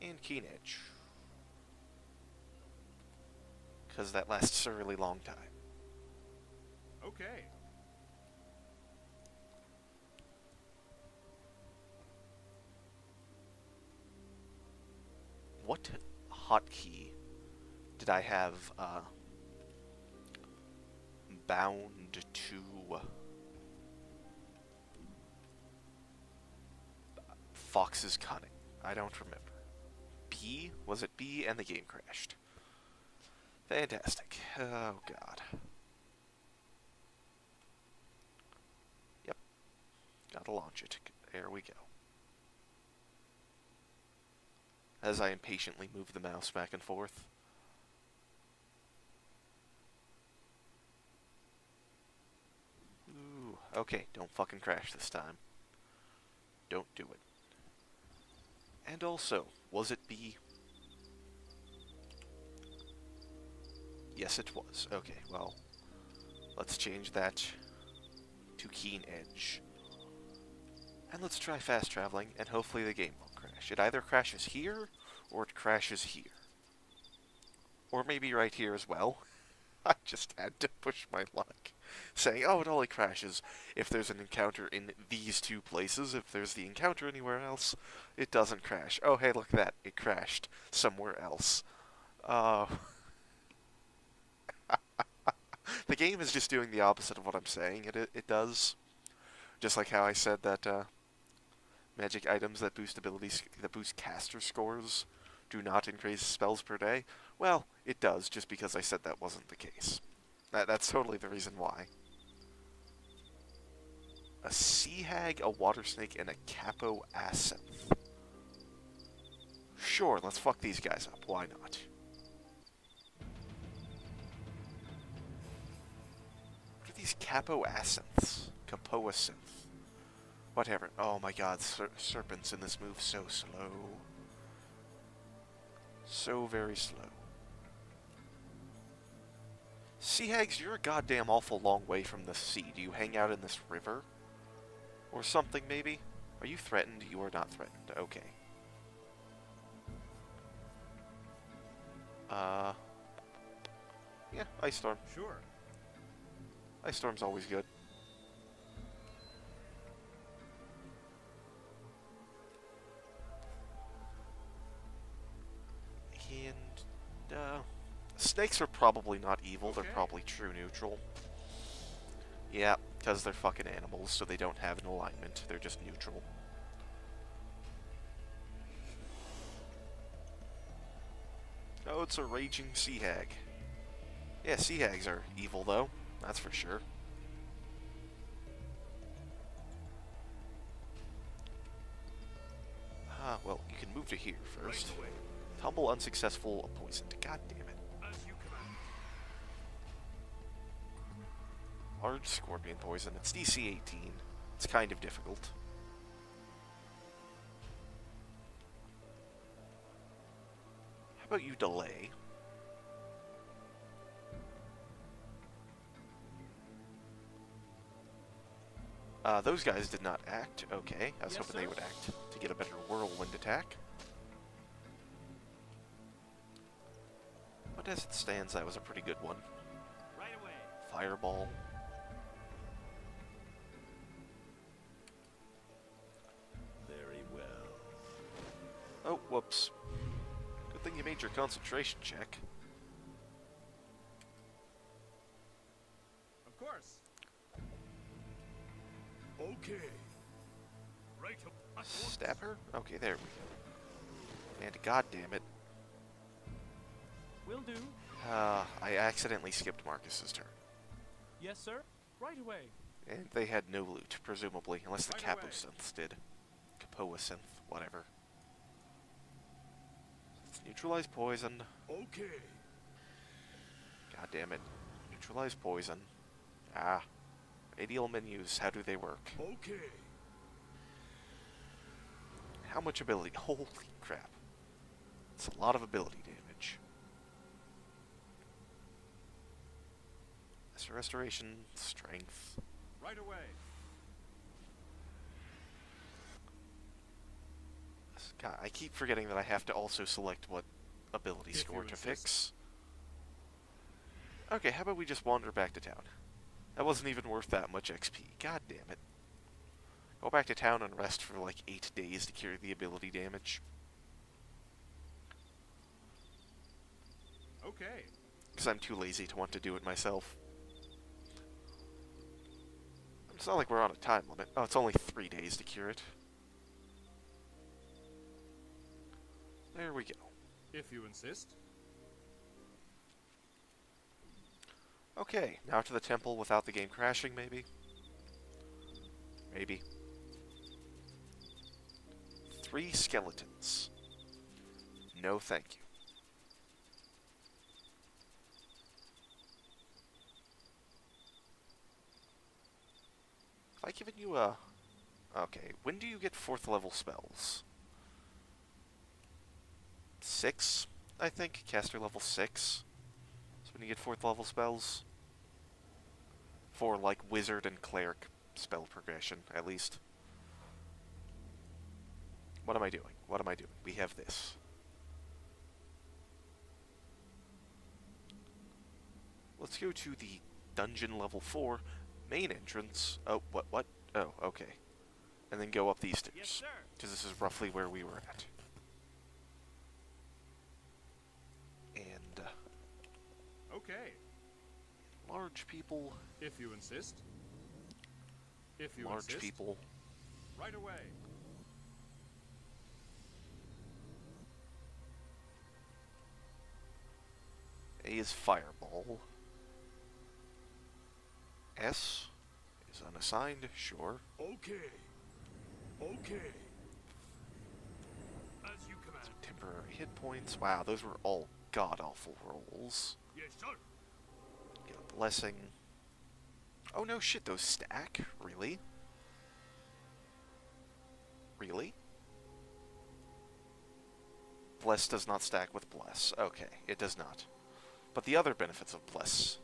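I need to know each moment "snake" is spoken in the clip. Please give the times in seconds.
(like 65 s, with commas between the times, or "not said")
115 s, 168 s.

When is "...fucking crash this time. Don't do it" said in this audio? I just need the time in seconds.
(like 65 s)
54 s.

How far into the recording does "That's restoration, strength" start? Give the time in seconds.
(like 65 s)
290 s.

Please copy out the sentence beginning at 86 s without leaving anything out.
If there's the encounter anywhere else, it doesn't crash.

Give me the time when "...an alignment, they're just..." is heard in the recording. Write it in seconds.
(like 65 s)
174 s.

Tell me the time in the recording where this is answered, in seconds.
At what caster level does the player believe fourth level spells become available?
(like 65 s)
361 s.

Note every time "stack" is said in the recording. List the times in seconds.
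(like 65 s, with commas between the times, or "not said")
427 s, 435 s.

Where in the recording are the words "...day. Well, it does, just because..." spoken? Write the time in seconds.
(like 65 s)
106 s.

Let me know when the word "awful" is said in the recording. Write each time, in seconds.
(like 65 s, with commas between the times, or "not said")
141 s, 422 s.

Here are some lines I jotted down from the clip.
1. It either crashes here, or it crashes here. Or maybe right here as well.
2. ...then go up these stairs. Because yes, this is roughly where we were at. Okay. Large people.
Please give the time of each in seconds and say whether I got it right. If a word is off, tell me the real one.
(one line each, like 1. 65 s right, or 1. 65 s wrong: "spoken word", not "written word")
1. 73 s right
2. 385 s right.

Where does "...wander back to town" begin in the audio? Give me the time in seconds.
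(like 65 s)
305 s.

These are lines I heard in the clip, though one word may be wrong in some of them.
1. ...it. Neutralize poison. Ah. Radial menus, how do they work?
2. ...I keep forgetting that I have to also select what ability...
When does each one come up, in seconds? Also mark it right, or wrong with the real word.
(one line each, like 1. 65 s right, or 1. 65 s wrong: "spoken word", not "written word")
1. 274 s right
2. 298 s right.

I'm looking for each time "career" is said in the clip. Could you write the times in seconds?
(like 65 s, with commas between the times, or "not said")
not said.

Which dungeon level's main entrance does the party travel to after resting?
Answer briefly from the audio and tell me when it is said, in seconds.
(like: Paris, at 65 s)
Level 4, at 380 s.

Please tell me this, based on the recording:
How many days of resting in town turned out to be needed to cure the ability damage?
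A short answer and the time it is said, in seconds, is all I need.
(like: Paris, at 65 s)
3, at 324 s.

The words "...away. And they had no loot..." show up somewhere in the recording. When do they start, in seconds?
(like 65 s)
262 s.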